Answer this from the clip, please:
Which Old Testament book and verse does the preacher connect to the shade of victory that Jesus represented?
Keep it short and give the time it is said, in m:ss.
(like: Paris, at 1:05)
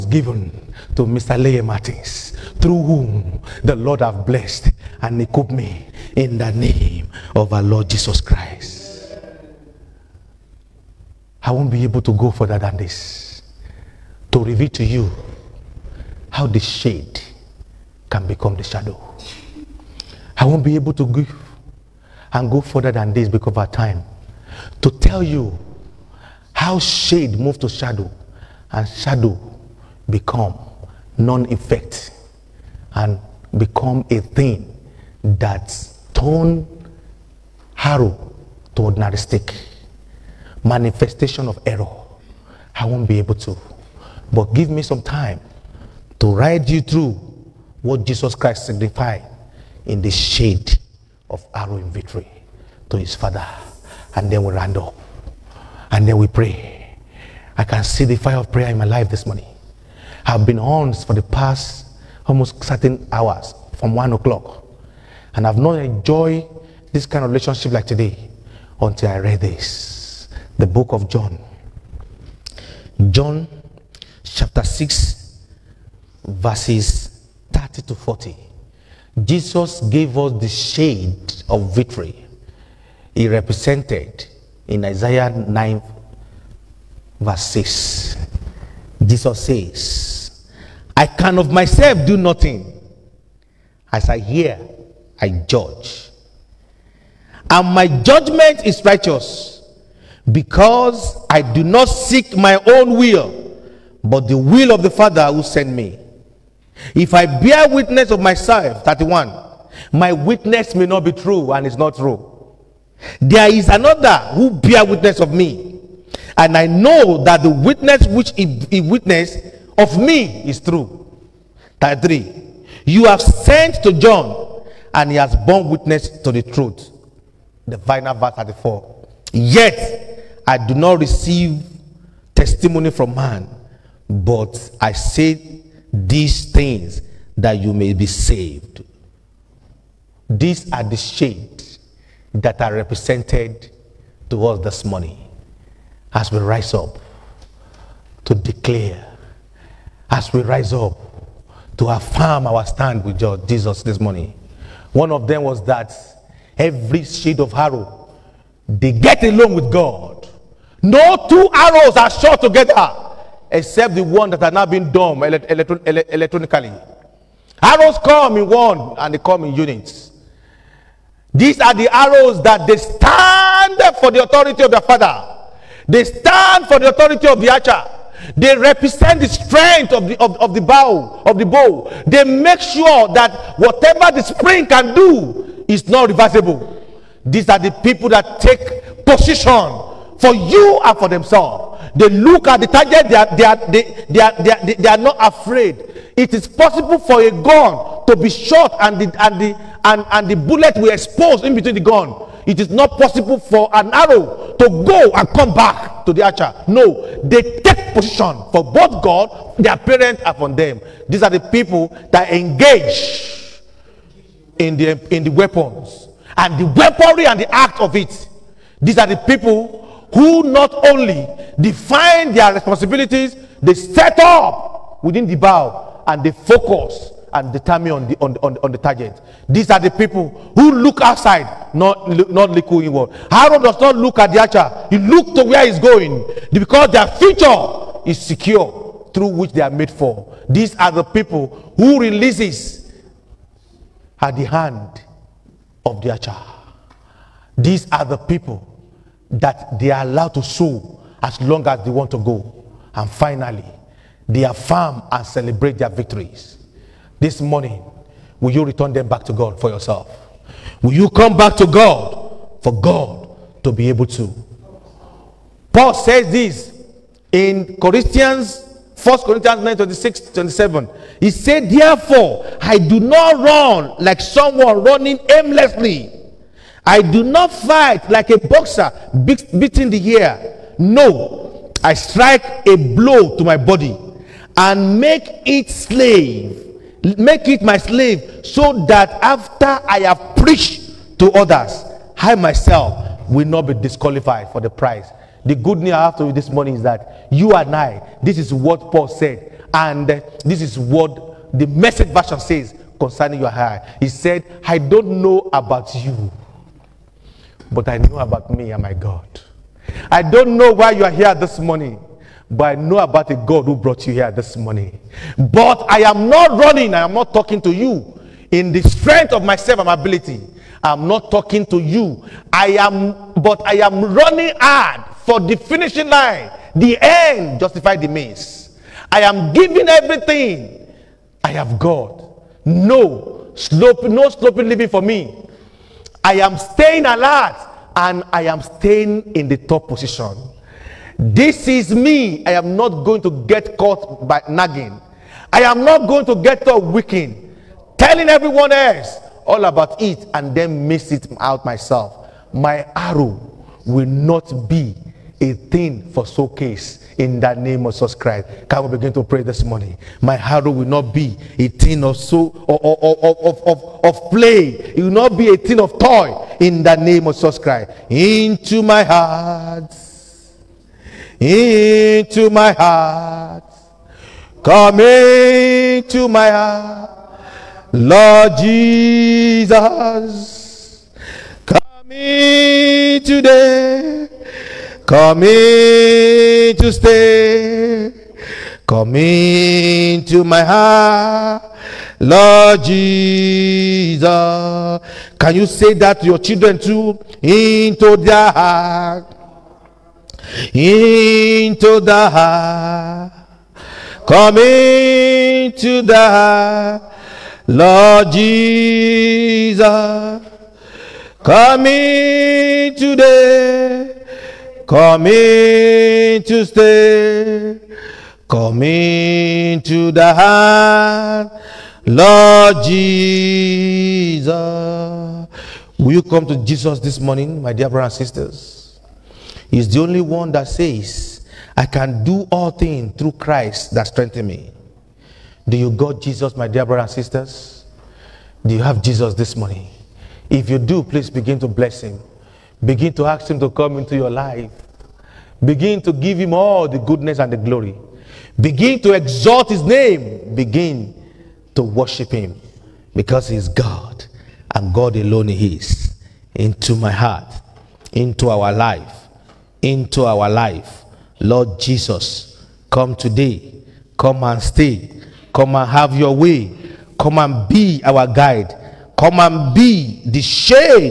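Isaiah 9:6, at 1:24.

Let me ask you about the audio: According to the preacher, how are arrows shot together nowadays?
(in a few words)
Electronically.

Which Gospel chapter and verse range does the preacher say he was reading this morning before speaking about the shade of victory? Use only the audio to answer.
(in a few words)
John 6:30-40.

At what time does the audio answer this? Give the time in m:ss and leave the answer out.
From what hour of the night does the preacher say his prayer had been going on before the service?
1:03.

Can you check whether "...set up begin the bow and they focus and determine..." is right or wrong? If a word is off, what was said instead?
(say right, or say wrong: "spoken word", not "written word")
wrong: "within", not "begin".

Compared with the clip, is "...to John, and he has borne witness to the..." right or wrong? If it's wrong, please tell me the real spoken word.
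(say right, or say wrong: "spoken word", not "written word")
right.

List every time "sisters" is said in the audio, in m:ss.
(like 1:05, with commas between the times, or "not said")
7:08, 7:17.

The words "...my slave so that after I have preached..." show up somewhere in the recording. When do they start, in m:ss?
4:47.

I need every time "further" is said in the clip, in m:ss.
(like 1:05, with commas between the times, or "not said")
0:12, 0:22.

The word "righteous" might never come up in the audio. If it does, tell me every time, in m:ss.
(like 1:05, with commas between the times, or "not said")
1:38.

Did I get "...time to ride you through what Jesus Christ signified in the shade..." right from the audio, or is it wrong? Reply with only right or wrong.
right.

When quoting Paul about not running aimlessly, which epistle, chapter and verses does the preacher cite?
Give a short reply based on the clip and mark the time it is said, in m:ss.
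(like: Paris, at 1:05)
1 Corinthians 9:26-27, at 4:29.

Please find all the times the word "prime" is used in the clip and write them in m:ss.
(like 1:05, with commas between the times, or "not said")
not said.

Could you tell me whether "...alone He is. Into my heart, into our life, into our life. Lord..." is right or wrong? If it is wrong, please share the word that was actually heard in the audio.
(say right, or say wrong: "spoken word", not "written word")
right.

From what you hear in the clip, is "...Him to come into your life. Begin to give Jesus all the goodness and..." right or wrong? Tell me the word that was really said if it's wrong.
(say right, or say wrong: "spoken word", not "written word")
wrong: "Him", not "Jesus".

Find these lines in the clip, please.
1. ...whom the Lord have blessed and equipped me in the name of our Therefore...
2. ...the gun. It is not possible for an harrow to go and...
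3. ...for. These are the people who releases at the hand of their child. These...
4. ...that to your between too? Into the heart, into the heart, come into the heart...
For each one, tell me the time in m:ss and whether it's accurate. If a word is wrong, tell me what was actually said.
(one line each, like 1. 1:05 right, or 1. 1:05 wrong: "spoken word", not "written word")
1. 0:02 wrong: "Lord", not "Therefore"
2. 3:21 wrong: "arrow", not "harrow"
3. 3:59 right
4. 6:35 wrong: "children", not "between".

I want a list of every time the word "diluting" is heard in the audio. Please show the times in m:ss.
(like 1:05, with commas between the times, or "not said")
not said.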